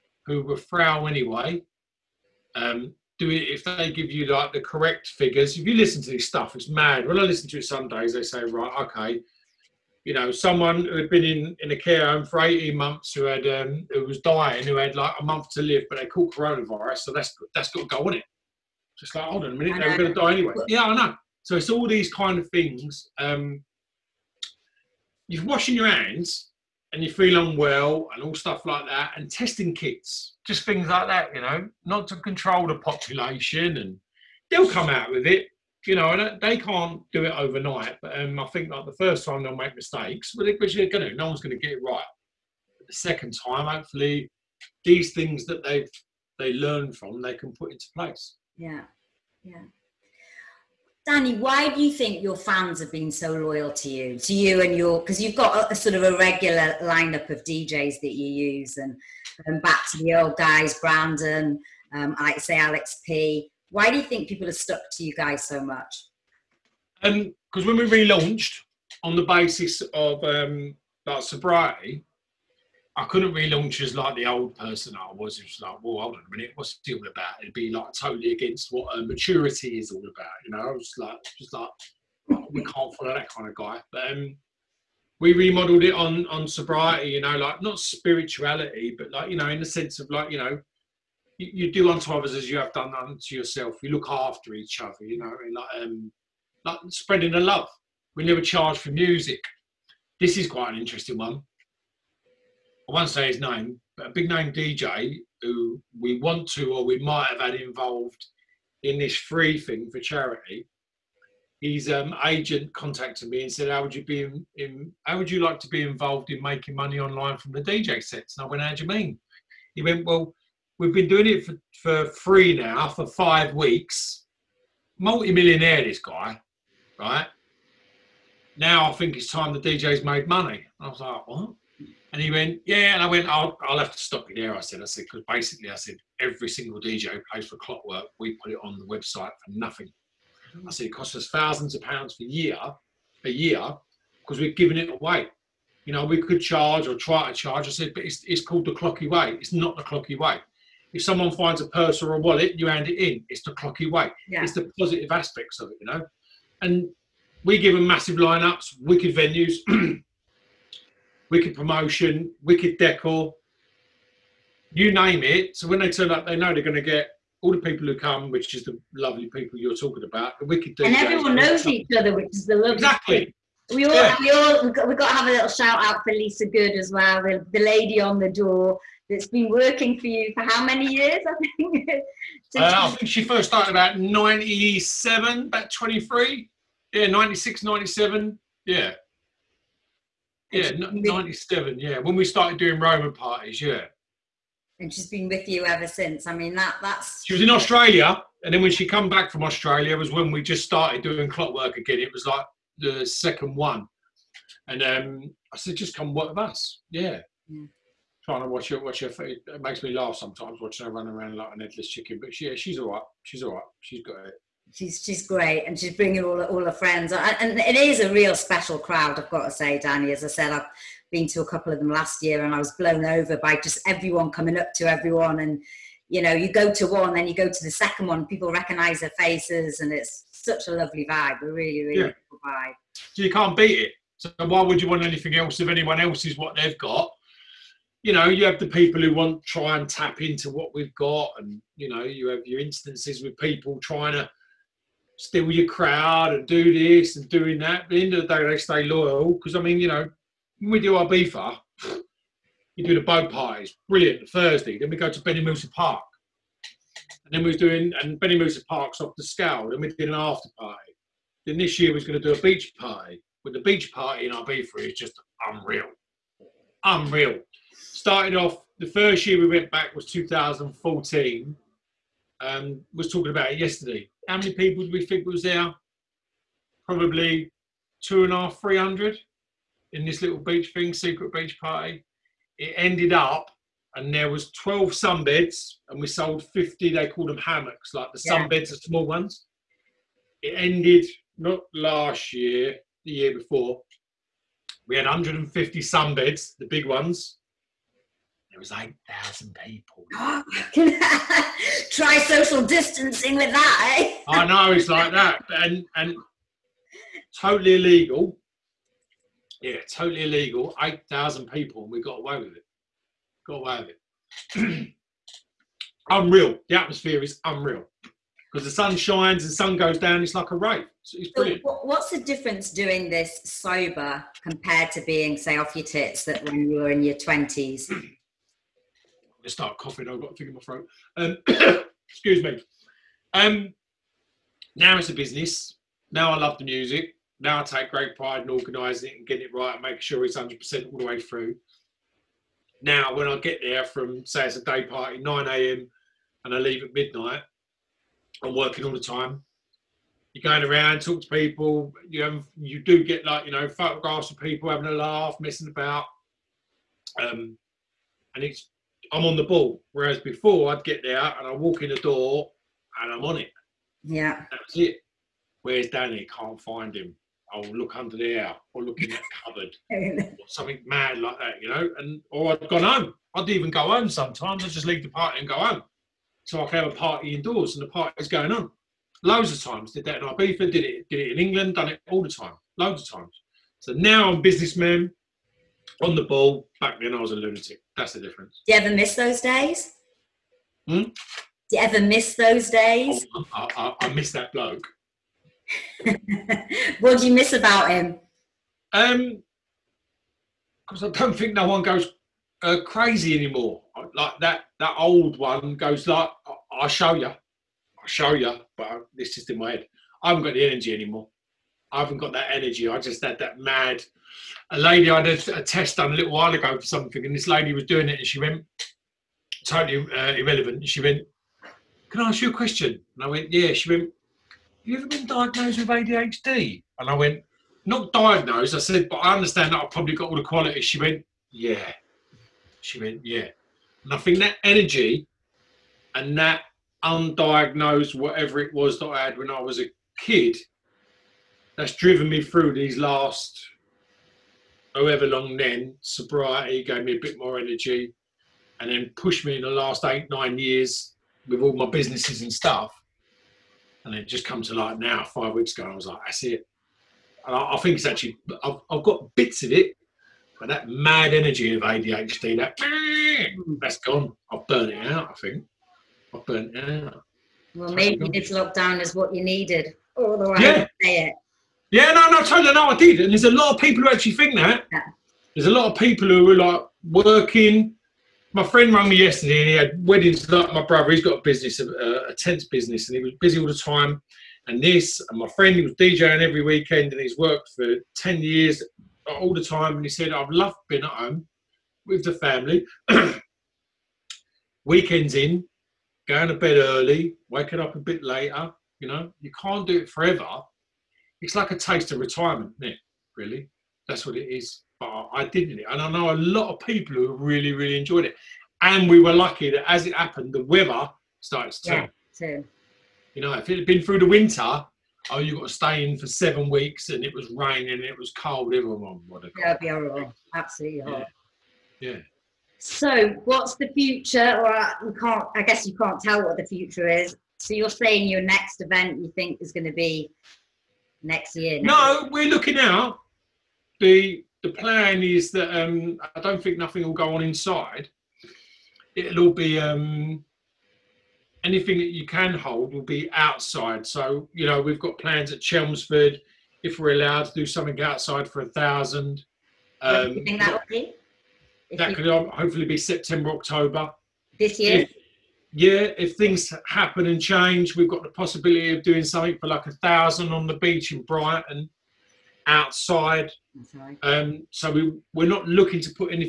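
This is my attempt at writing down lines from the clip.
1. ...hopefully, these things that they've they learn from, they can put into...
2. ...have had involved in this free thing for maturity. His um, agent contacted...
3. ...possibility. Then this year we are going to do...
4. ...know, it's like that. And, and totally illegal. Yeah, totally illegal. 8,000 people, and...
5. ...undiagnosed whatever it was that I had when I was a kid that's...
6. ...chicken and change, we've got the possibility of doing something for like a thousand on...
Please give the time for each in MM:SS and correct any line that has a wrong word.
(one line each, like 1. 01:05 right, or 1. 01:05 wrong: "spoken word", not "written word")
1. 00:43 right
2. 01:47 wrong: "charity", not "maturity"
3. 04:20 wrong: "party", not "possibility"
4. 05:04 right
5. 07:17 right
6. 09:16 wrong: "happen", not "chicken".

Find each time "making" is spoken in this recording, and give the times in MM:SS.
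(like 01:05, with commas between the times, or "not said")
01:56, 05:39.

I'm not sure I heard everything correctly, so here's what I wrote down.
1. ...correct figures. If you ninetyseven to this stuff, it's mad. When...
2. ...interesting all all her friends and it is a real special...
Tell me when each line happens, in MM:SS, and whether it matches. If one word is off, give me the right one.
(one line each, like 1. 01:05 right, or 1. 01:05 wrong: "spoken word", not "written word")
1. 00:04 wrong: "listen", not "ninetyseven"
2. 03:35 wrong: "bringing", not "interesting".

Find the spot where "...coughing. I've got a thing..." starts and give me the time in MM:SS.
05:29.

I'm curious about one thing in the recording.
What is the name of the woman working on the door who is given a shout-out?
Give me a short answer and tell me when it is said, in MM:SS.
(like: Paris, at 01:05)
Lisa Good, at 02:56.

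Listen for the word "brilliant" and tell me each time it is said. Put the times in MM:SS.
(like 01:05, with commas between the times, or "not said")
04:13, 05:21.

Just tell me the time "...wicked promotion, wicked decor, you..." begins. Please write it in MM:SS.
02:41.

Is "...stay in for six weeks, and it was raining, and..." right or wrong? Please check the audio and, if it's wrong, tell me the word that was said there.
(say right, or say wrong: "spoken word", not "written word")
wrong: "seven", not "six".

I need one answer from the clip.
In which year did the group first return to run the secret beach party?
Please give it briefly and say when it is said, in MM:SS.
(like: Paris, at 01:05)
2014, at 04:30.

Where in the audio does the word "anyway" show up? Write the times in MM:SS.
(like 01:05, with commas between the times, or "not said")
00:01, 00:20.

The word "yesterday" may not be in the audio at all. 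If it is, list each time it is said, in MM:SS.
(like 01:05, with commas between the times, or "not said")
04:33, 07:59.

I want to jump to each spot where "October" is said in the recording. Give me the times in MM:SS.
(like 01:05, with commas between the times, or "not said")
09:13.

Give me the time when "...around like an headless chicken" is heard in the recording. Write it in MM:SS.
03:31.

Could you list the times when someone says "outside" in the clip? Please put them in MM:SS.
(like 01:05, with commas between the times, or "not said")
09:03, 09:08, 09:22.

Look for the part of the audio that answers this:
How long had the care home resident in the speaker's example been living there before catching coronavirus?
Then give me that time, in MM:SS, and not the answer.
00:12.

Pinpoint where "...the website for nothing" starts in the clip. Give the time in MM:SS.
02:18.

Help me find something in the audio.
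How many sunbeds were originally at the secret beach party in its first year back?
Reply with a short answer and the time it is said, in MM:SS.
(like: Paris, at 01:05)
12, at 04:44.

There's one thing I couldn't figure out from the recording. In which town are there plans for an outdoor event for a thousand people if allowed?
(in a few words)
Chelmsford.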